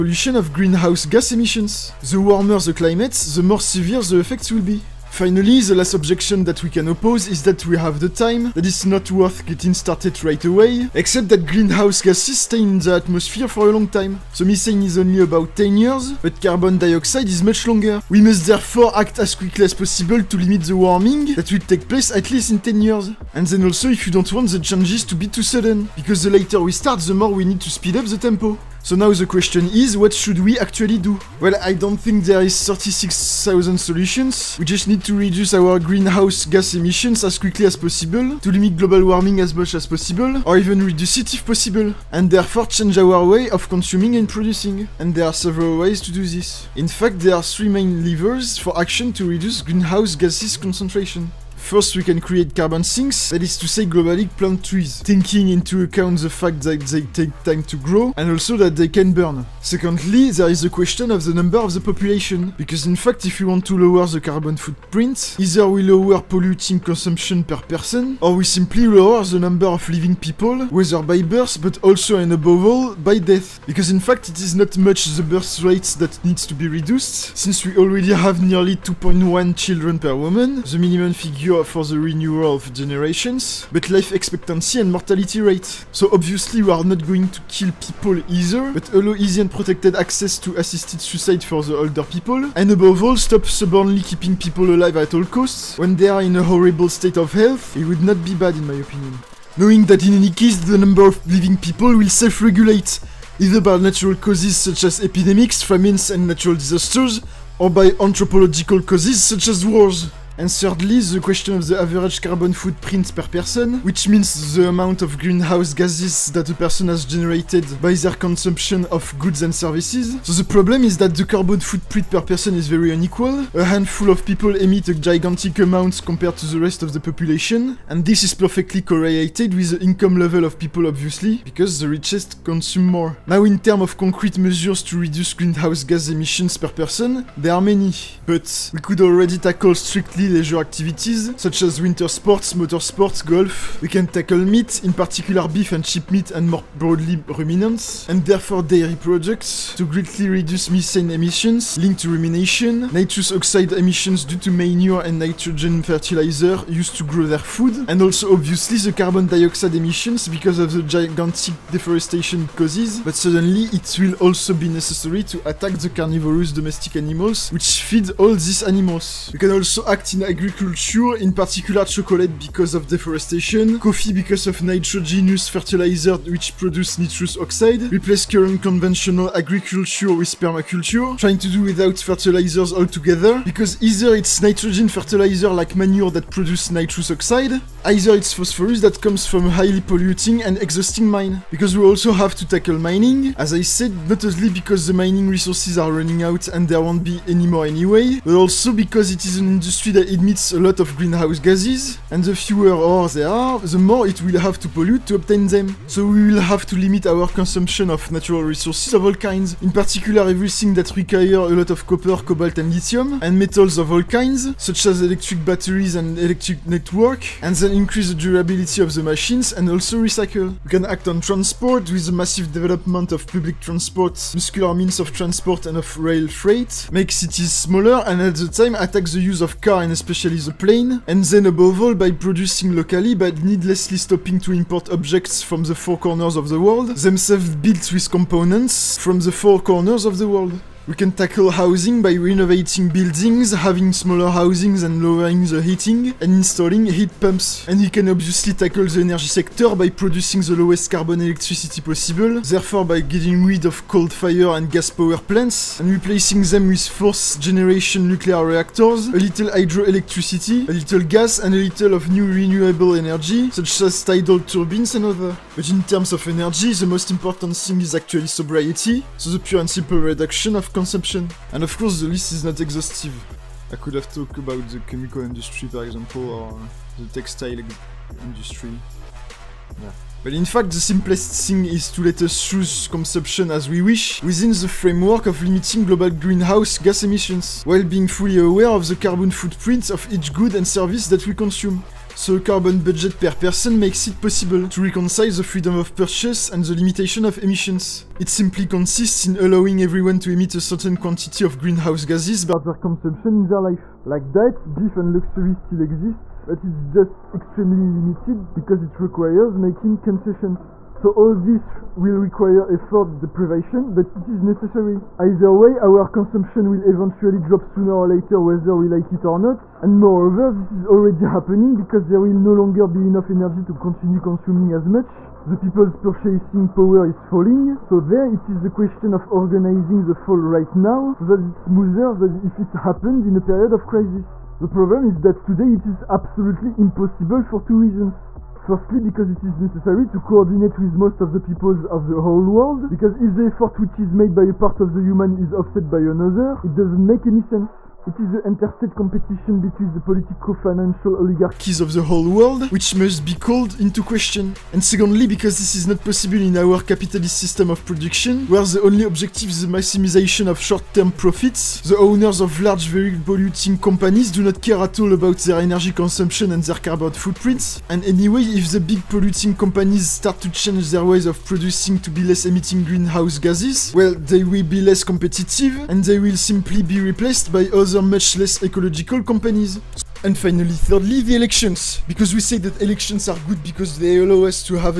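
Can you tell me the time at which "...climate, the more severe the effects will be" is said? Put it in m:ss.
0:02.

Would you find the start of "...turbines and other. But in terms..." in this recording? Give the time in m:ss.
4:24.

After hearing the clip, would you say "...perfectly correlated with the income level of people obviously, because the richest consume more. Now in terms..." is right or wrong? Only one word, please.
right.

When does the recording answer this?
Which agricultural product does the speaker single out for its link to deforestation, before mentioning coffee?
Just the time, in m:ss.
2:51.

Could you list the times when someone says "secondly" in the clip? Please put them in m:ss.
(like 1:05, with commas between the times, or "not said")
0:59, 5:54.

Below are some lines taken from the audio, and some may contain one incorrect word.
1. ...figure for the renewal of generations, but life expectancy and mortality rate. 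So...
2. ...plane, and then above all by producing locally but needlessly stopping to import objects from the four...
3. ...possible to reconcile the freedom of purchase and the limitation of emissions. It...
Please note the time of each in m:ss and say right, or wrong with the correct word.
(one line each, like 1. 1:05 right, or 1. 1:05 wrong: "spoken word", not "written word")
1. 1:21 right
2. 3:50 right
3. 4:54 right.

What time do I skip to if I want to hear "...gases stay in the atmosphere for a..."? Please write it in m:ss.
0:12.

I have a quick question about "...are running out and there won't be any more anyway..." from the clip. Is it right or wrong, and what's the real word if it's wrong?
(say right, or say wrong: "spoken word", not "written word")
right.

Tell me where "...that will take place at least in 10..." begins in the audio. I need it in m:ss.
0:21.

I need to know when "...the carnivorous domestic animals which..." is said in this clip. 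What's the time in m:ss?
2:45.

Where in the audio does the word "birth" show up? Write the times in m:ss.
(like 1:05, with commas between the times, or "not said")
1:11, 1:15.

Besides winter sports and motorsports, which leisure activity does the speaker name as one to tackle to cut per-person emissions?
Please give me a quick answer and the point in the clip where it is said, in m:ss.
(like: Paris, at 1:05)
golf, at 2:23.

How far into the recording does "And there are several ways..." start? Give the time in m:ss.
0:44.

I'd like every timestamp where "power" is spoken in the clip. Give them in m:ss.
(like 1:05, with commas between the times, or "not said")
4:14, 5:26.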